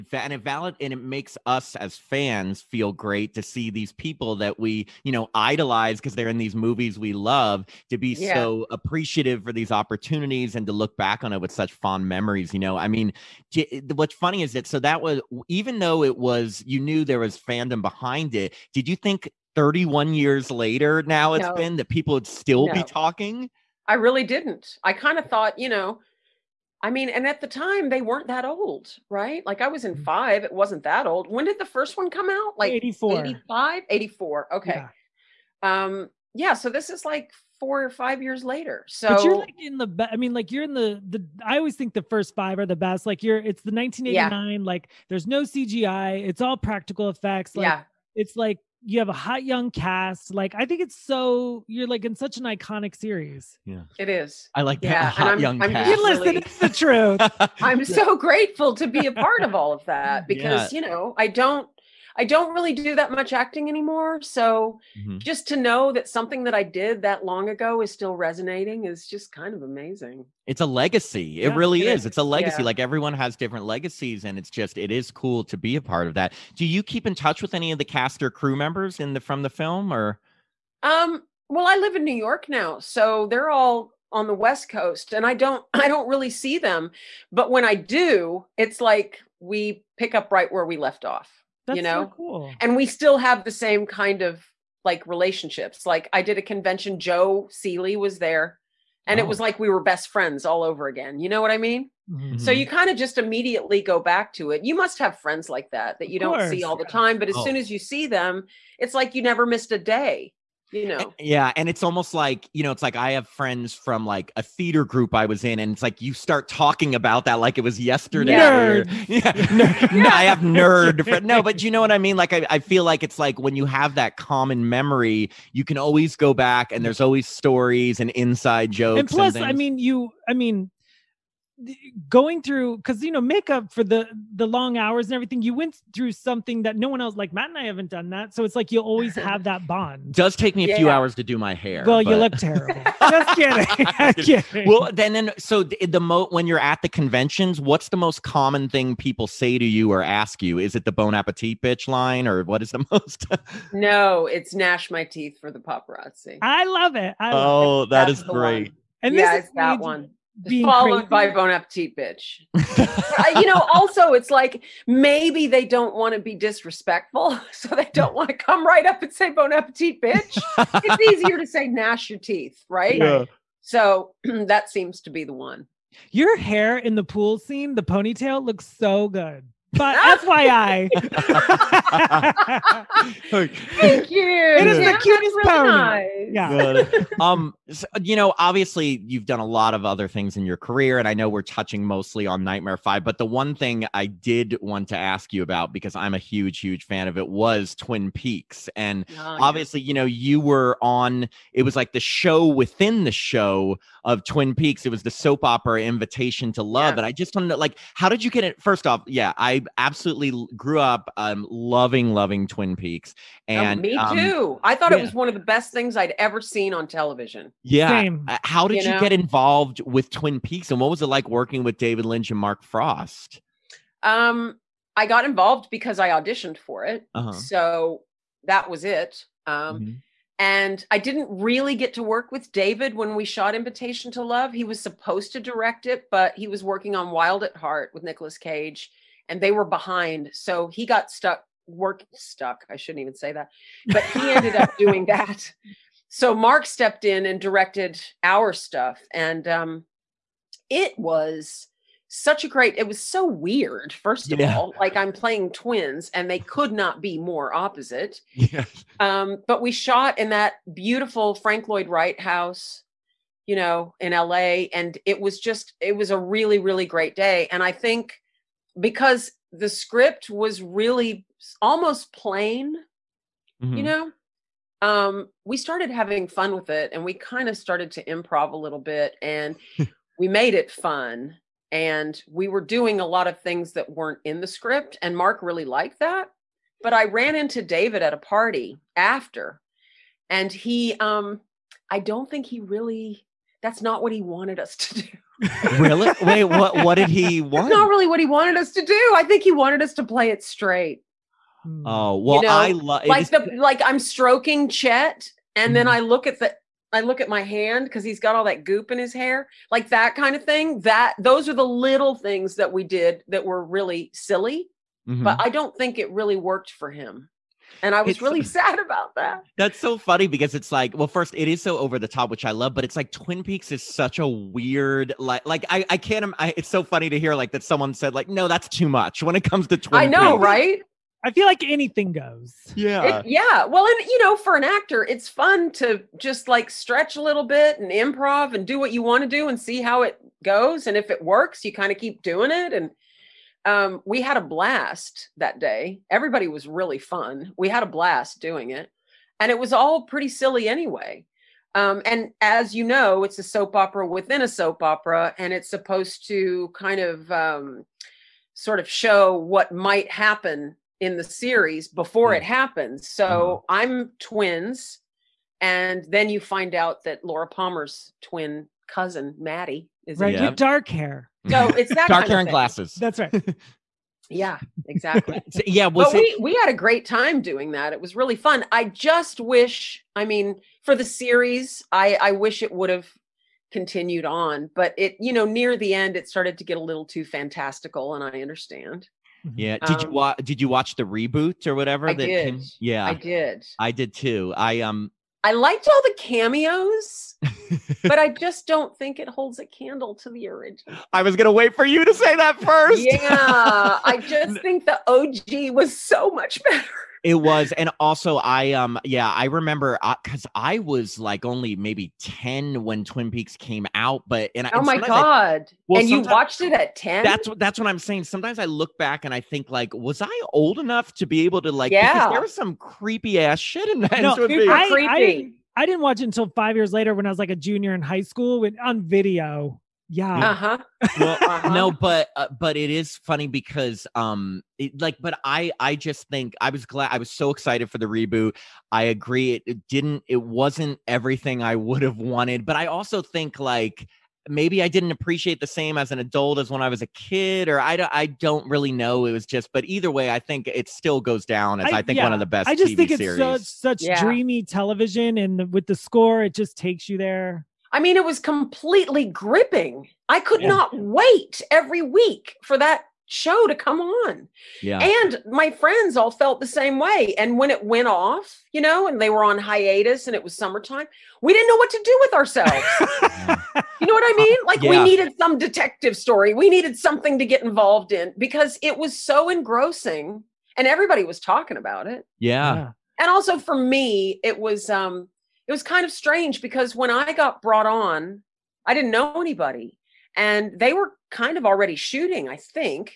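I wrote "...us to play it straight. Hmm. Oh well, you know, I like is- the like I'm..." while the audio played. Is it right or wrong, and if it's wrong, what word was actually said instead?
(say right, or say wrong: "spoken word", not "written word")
right.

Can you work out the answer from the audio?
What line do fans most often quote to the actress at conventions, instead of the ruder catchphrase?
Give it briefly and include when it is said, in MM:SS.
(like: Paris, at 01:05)
gnash my teeth for the paparazzi, at 02:34.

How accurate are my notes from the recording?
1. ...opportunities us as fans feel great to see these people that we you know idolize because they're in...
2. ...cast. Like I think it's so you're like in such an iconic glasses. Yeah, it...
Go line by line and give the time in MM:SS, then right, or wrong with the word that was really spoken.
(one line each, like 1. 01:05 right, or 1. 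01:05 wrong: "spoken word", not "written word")
1. 00:01 wrong: "makes", not "opportunities"
2. 00:49 wrong: "series", not "glasses".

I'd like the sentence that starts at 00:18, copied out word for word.
Did you think 31 years later now it's no.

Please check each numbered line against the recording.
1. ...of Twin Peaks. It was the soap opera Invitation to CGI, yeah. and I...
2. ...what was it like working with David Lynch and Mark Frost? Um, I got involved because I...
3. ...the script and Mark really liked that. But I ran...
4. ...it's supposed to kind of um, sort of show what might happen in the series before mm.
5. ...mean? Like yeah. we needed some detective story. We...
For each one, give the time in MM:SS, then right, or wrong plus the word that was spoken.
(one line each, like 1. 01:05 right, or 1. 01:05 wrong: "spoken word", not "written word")
1. 03:24 wrong: "Love", not "CGI"
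2. 03:40 right
3. 04:44 right
4. 05:55 right
5. 07:54 right.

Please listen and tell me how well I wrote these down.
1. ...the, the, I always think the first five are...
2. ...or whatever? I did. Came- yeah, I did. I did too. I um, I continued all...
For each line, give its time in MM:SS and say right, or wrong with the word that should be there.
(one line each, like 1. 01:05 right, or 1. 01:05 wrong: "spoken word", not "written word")
1. 00:40 right
2. 06:31 wrong: "liked", not "continued".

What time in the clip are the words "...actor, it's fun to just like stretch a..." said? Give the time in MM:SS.
05:34.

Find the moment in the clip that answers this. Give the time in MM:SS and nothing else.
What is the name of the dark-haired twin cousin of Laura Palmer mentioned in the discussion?
06:09.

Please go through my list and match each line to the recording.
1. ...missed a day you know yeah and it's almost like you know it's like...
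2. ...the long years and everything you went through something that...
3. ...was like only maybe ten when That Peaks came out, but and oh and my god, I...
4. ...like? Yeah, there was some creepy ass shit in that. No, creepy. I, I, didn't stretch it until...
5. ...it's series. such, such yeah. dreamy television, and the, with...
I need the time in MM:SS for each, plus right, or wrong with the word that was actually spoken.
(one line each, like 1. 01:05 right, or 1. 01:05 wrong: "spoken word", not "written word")
1. 01:49 right
2. 02:14 wrong: "hours", not "years"
3. 06:50 wrong: "Twin", not "That"
4. 07:01 wrong: "watch", not "stretch"
5. 07:33 right.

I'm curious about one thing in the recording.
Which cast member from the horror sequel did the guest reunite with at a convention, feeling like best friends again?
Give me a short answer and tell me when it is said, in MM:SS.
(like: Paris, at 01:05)
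Joe Seely, at 01:36.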